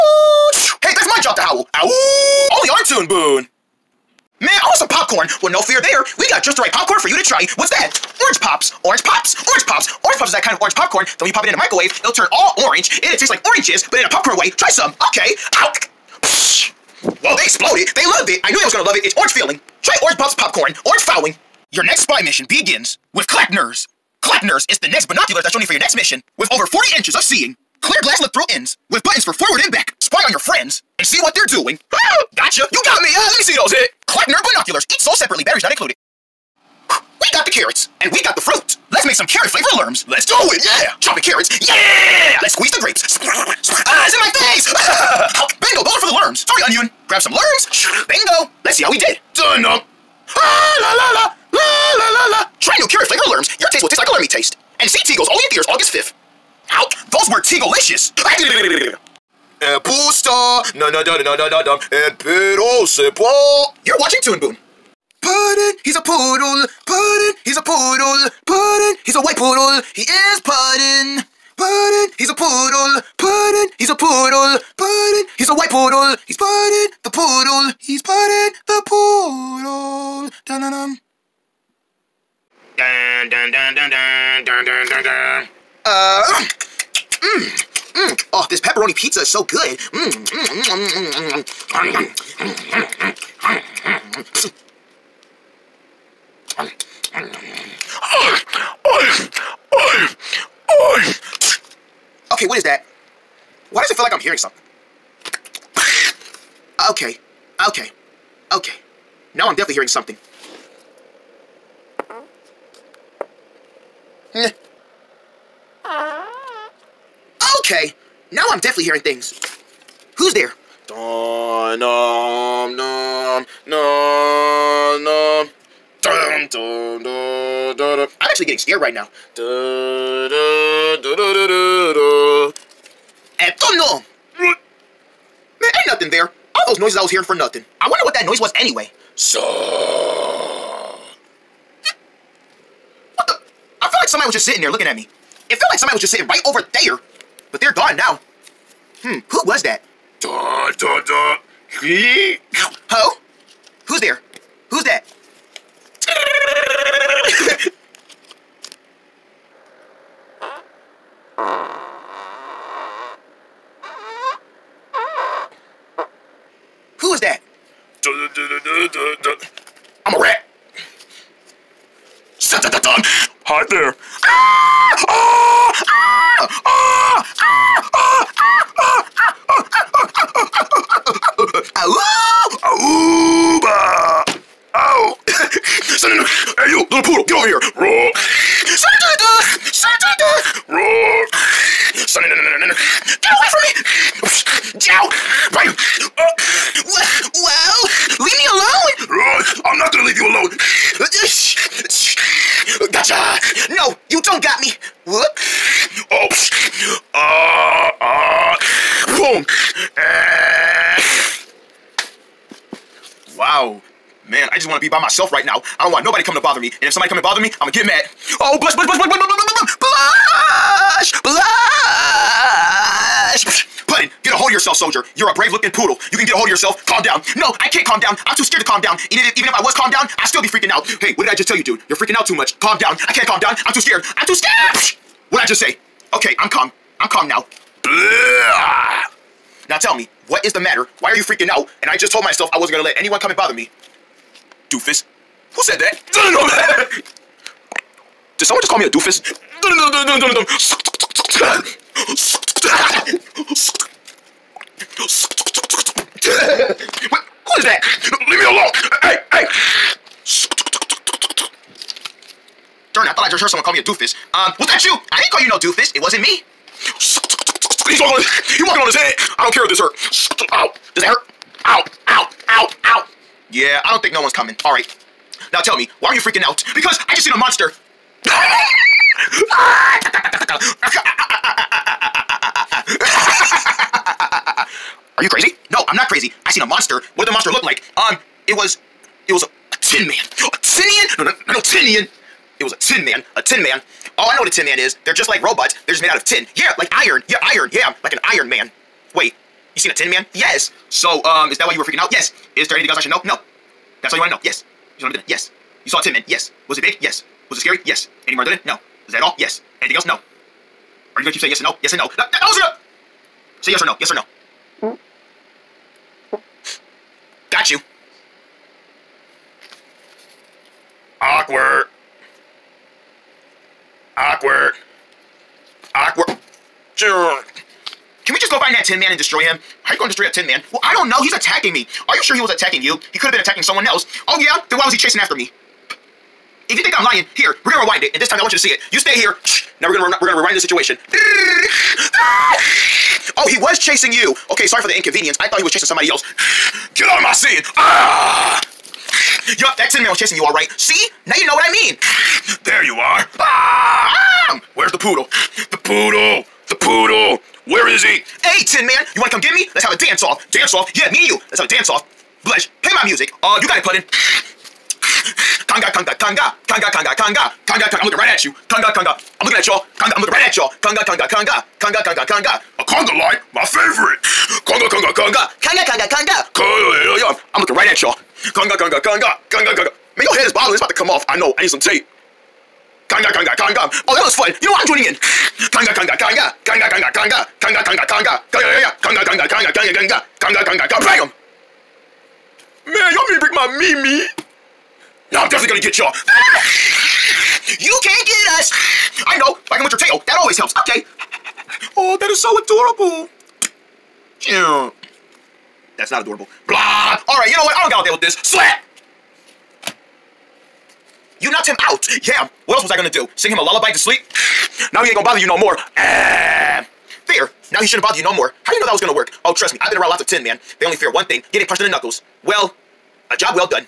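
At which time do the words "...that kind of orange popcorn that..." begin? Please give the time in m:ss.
0:10.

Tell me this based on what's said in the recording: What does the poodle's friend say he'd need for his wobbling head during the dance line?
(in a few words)
Tape.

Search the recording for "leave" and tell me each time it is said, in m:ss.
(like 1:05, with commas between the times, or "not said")
4:18.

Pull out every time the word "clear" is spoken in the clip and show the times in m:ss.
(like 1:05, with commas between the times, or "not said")
0:27.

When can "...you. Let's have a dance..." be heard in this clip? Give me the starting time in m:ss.
6:01.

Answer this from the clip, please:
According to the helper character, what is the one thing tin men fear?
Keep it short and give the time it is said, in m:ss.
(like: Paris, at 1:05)
Getting punched in the knuckles, at 7:01.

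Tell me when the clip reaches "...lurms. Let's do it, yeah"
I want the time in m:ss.
0:39.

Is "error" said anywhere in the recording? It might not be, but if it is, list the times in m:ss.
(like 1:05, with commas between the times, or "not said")
not said.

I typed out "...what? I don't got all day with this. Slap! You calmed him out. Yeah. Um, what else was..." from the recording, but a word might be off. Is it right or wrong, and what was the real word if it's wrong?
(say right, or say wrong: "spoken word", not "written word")
wrong: "knocked", not "calmed".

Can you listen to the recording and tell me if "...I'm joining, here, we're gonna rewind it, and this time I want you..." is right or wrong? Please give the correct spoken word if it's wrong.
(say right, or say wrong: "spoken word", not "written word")
wrong: "lying", not "joining".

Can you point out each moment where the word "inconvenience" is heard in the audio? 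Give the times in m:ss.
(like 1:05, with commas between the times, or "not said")
5:44.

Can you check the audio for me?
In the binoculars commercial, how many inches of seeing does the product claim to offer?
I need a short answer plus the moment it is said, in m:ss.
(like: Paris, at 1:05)
40, at 0:26.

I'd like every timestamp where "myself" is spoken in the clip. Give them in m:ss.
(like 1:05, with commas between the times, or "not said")
3:35, 4:02.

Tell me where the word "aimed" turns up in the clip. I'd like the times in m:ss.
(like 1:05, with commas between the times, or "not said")
not said.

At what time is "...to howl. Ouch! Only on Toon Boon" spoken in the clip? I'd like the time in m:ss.
0:01.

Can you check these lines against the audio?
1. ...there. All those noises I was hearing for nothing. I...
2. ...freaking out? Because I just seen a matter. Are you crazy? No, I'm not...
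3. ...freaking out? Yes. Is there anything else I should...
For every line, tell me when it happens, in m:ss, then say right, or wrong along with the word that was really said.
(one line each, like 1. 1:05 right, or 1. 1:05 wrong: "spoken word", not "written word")
1. 2:16 right
2. 4:36 wrong: "monster", not "matter"
3. 5:01 right.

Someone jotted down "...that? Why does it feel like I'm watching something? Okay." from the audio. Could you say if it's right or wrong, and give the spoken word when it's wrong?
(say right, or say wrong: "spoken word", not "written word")
wrong: "hearing", not "watching".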